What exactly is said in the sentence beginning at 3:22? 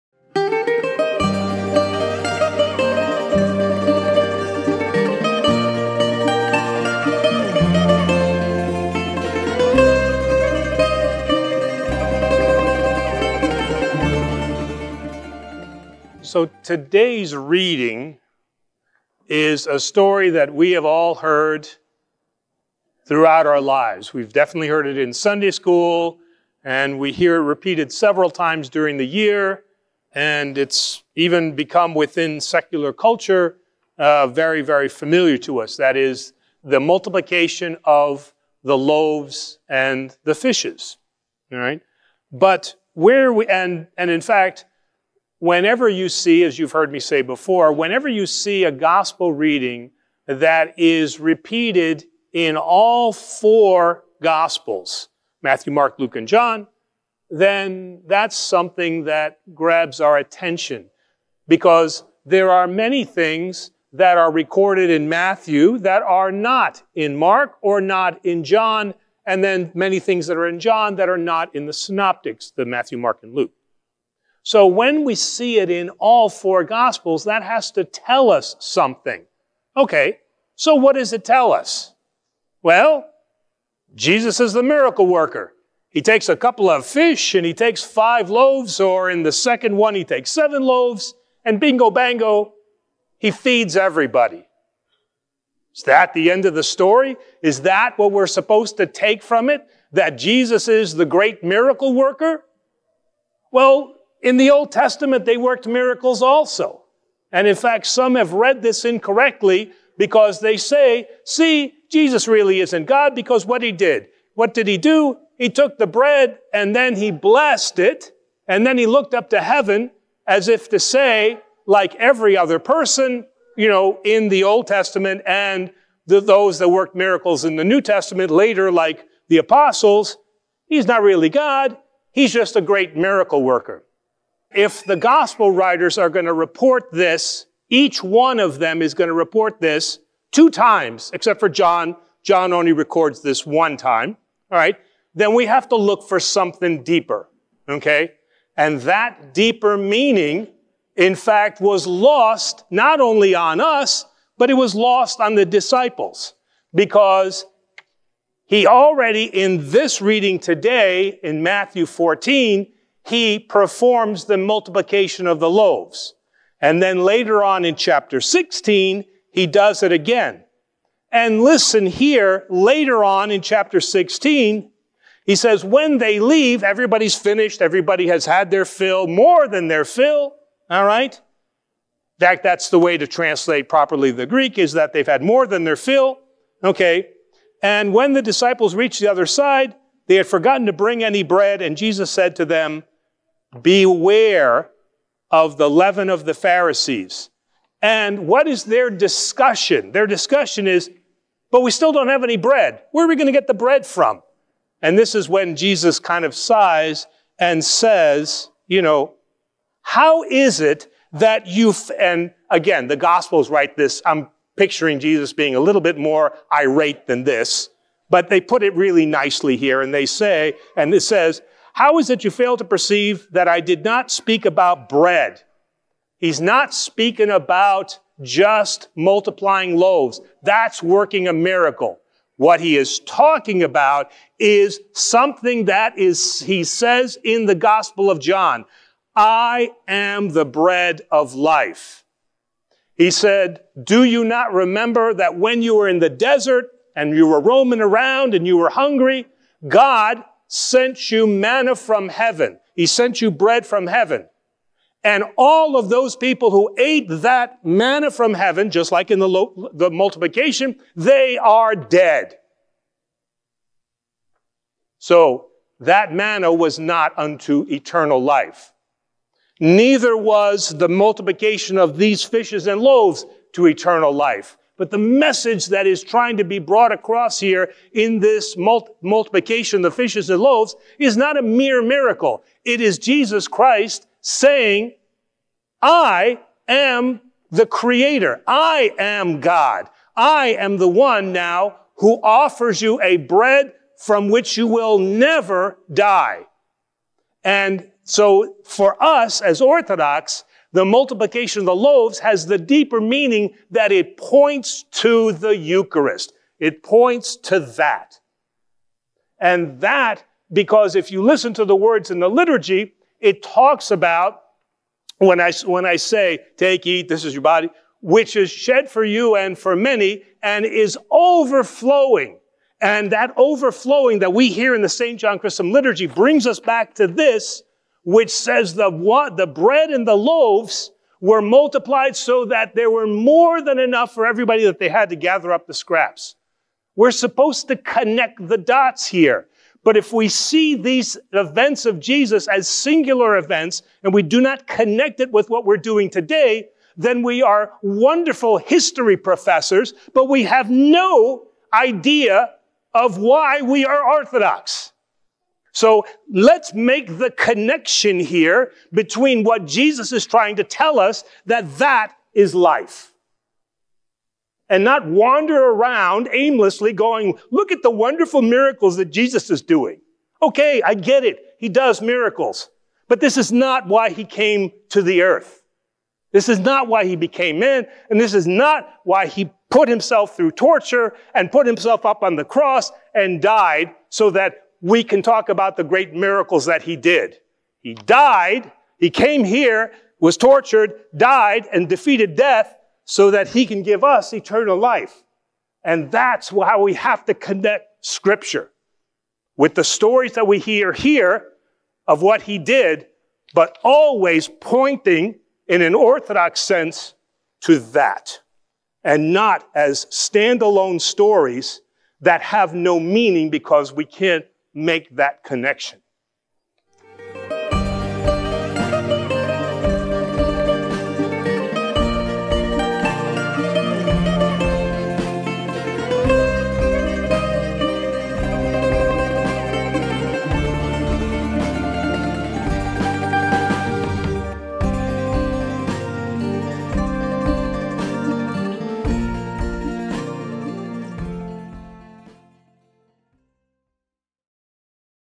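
Where are we going to get the bread from?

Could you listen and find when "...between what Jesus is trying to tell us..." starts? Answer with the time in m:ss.
5:58.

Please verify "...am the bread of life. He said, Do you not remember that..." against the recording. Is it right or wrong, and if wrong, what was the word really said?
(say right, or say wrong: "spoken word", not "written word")
right.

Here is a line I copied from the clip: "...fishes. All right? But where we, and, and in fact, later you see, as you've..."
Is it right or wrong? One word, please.
wrong.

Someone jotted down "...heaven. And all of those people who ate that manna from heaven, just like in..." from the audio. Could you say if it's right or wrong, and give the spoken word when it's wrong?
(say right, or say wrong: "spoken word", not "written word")
right.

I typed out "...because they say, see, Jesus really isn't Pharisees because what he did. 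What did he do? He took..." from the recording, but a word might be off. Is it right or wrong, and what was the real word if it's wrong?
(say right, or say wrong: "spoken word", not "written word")
wrong: "God", not "Pharisees".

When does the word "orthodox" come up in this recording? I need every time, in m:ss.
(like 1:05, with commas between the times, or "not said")
4:59, 5:54, 6:45.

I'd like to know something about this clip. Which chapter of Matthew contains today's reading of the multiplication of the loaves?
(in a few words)
Matthew 14.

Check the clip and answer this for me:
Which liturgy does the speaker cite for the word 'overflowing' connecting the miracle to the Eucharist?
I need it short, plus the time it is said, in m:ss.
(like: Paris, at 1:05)
St. John Chrysostom liturgy, at 5:24.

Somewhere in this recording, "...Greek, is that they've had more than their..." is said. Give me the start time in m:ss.
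3:04.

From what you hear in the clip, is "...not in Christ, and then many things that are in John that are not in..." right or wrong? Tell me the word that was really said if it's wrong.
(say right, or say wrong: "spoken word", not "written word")
wrong: "John", not "Christ".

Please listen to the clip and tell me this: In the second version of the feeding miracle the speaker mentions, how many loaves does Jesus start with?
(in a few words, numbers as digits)
7.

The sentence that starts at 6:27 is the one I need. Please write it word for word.
He died, he came here, was tortured, died, and defeated death so that he can give us eternal life.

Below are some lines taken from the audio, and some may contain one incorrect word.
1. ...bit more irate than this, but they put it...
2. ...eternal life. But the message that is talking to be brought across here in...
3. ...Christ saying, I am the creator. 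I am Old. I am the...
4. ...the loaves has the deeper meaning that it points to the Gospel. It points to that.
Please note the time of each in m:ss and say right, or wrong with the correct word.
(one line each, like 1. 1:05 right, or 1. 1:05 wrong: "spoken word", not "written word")
1. 3:35 right
2. 4:33 wrong: "trying", not "talking"
3. 4:43 wrong: "God", not "Old"
4. 5:01 wrong: "Eucharist", not "Gospel".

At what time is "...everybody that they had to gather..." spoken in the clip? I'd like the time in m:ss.
5:34.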